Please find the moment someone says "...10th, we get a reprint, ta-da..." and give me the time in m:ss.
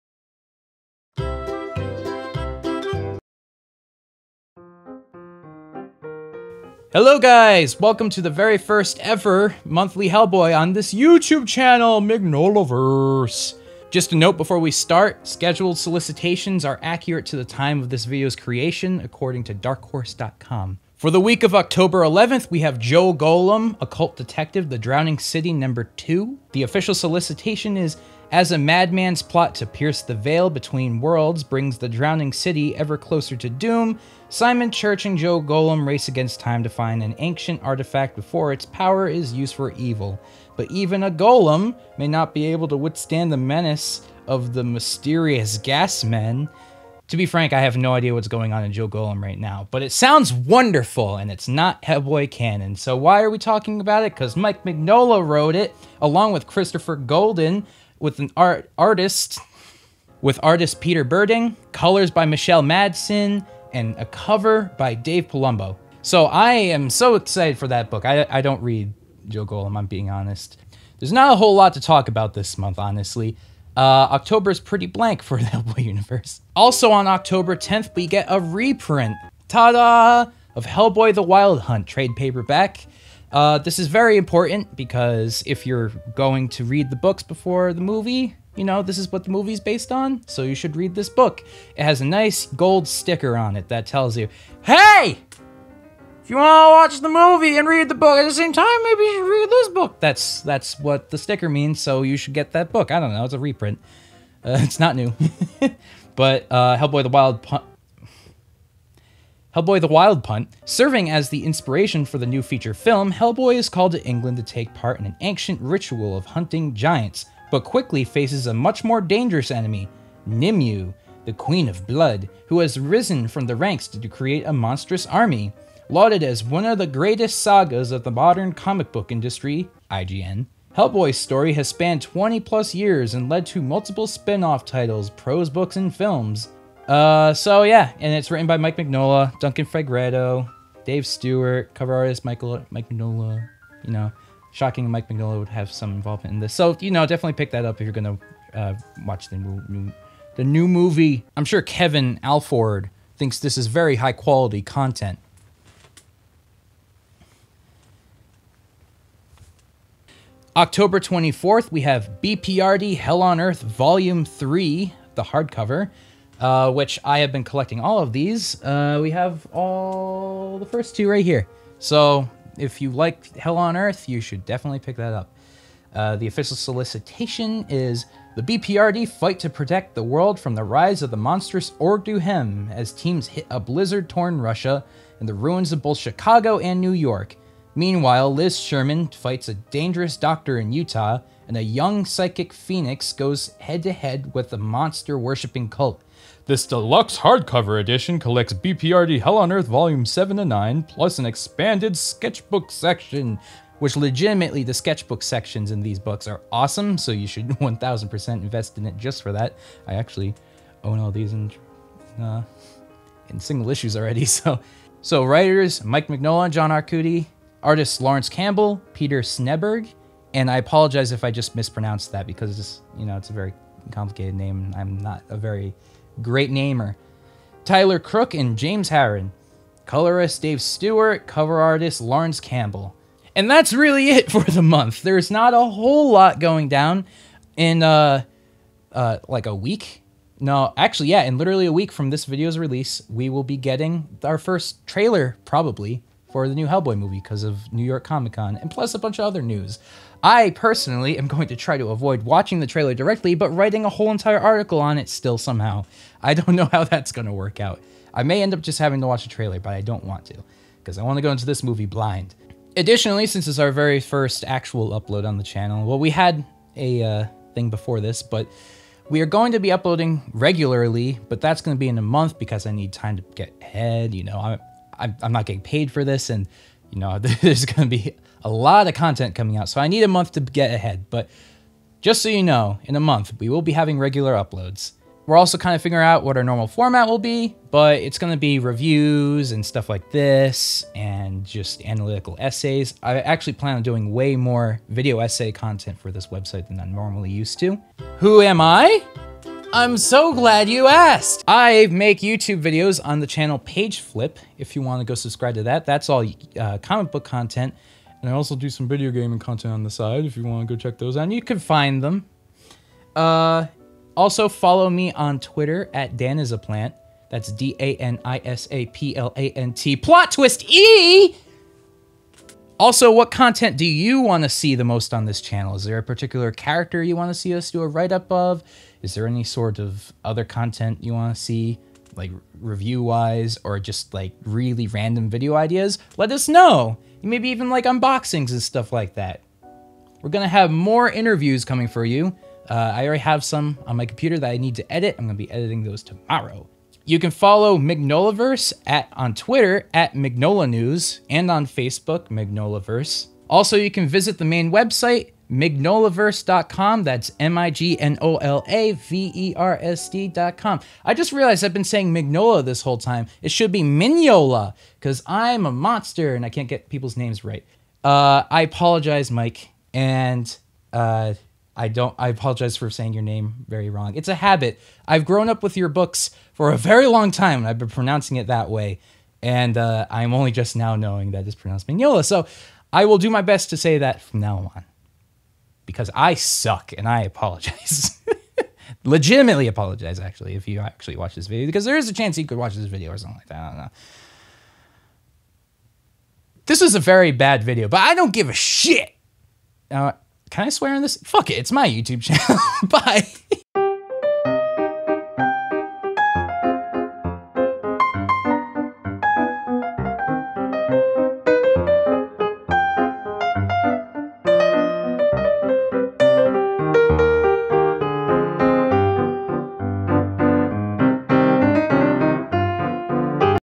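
1:17.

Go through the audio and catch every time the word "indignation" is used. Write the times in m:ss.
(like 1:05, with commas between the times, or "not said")
not said.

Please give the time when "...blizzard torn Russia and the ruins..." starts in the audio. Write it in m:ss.
3:03.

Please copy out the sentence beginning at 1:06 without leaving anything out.
So I am so excited for that book.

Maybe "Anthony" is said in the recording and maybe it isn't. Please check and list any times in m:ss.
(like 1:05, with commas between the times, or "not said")
not said.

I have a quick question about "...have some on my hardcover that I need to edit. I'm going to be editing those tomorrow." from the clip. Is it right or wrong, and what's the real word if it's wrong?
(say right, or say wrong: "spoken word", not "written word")
wrong: "computer", not "hardcover".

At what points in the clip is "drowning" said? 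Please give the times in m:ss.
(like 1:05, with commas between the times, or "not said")
0:24, 0:31.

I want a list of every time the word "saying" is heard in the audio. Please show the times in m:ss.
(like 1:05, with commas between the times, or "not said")
6:01, 6:12.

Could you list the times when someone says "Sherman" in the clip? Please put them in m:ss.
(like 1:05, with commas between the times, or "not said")
3:08.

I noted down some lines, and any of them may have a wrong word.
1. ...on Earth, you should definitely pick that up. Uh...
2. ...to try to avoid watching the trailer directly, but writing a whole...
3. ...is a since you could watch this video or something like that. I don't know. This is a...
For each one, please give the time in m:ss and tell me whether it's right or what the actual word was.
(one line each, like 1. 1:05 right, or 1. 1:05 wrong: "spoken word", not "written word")
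1. 2:53 right
2. 4:11 right
3. 6:31 wrong: "chance", not "since".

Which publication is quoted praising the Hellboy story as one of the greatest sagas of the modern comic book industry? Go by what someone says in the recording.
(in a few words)
IGN.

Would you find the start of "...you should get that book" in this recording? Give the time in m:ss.
1:42.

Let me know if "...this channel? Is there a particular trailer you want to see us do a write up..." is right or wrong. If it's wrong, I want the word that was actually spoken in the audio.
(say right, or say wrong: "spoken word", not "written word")
wrong: "character", not "trailer".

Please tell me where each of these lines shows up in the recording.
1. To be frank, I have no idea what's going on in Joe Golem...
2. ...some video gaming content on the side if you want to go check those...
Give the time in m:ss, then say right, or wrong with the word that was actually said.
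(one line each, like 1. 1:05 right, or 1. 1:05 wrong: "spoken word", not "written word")
1. 0:47 right
2. 5:08 right.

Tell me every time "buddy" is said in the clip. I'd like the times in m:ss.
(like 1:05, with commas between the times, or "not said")
not said.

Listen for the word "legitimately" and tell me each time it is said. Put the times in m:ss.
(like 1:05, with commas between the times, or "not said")
3:23, 6:29.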